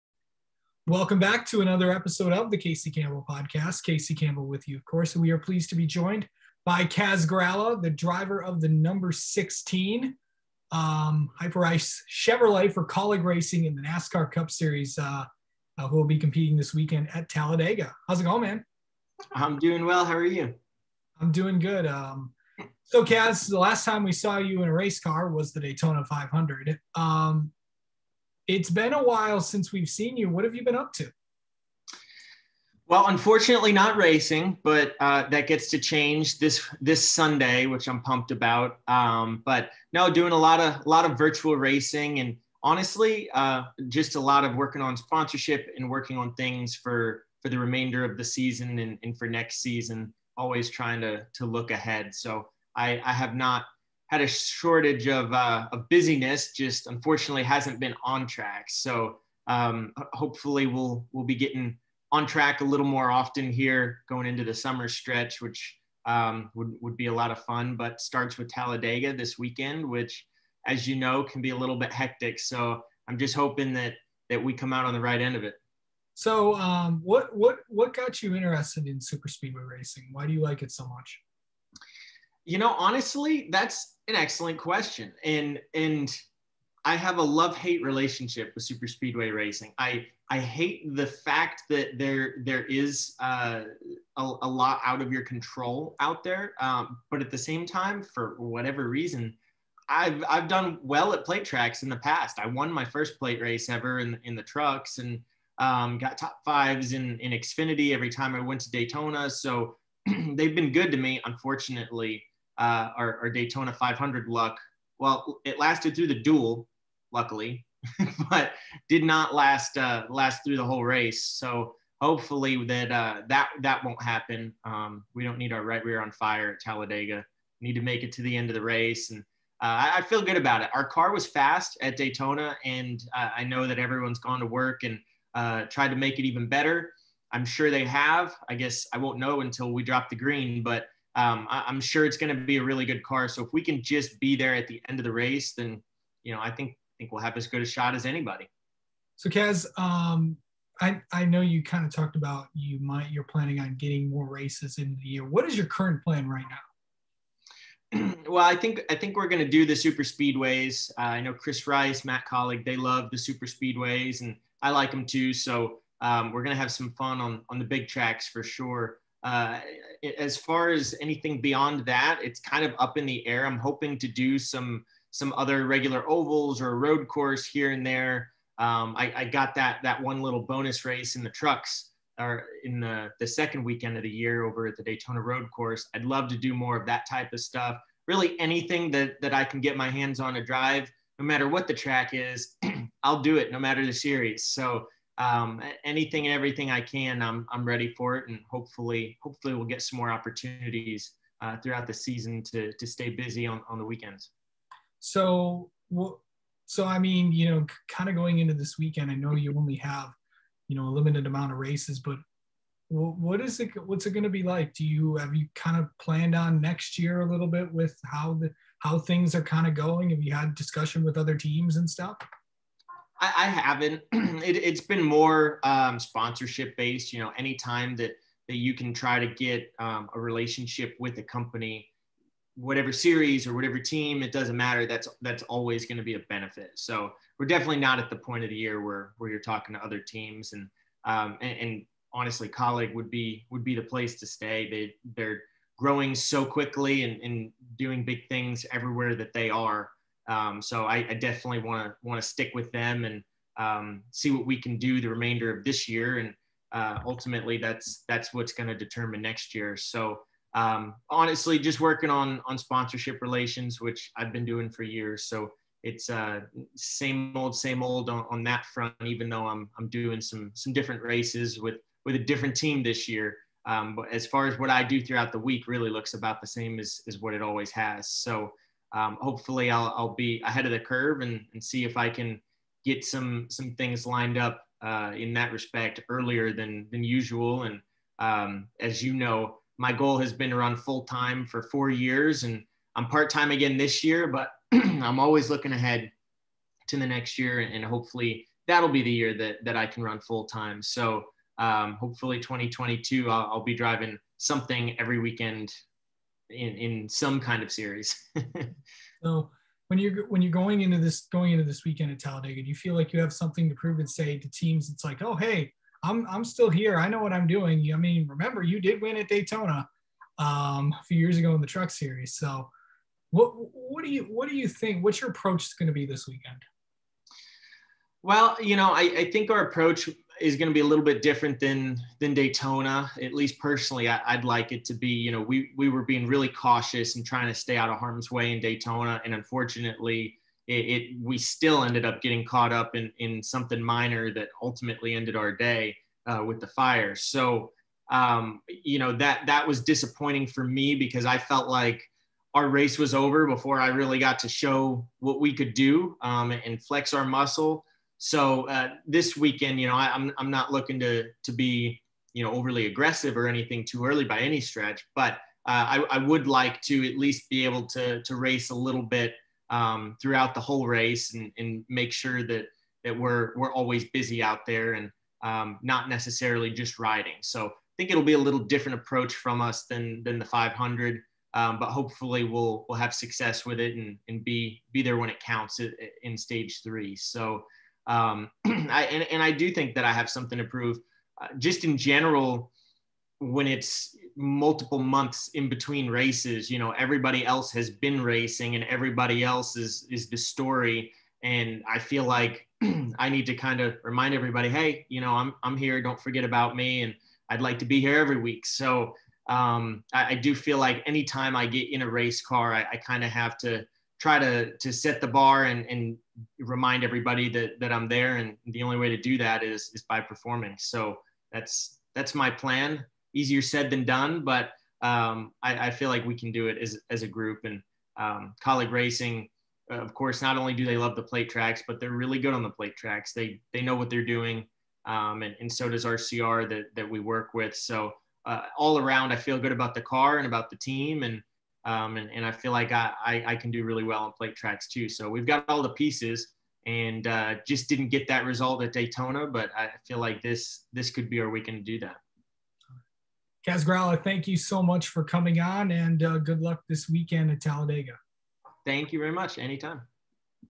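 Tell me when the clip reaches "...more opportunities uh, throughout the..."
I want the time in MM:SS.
03:19.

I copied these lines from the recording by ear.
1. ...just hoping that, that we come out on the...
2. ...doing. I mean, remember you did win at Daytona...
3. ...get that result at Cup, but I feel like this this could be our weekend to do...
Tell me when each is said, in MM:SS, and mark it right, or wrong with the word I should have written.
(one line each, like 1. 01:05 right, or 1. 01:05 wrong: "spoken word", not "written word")
1. 01:13 right
2. 05:17 right
3. 07:28 wrong: "Daytona", not "Cup".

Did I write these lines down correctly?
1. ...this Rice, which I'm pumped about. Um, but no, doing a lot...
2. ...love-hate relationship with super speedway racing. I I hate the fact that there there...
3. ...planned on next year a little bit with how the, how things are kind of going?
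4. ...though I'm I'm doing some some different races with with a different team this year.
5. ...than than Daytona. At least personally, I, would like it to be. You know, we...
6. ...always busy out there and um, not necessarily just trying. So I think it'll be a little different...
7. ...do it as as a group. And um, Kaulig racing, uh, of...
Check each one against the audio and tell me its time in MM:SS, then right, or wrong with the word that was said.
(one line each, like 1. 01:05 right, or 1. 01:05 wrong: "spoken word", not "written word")
1. 00:36 wrong: "Sunday", not "Rice"
2. 01:27 right
3. 03:36 right
4. 04:29 right
5. 05:31 right
6. 06:13 wrong: "riding", not "trying"
7. 07:06 right.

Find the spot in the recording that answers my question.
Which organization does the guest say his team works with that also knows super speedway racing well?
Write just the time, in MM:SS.
07:16.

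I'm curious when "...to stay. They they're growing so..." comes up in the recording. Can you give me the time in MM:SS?
04:04.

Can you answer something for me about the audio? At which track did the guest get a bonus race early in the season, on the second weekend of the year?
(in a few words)
Daytona Road Course.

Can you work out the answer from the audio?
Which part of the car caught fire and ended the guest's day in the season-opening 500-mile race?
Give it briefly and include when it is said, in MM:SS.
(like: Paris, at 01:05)
right rear, at 02:05.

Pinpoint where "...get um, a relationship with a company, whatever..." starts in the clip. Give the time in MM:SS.
03:49.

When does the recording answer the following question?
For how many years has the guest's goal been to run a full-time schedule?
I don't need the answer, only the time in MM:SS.
04:51.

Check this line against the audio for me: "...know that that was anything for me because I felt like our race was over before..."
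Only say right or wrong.
wrong.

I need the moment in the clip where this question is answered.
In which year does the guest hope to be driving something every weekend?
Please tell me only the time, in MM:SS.
05:02.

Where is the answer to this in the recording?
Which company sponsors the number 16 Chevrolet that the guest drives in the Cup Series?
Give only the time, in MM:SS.
00:11.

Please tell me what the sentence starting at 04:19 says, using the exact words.
So um, honestly, just working on on sponsorship relations, which I've been doing for years.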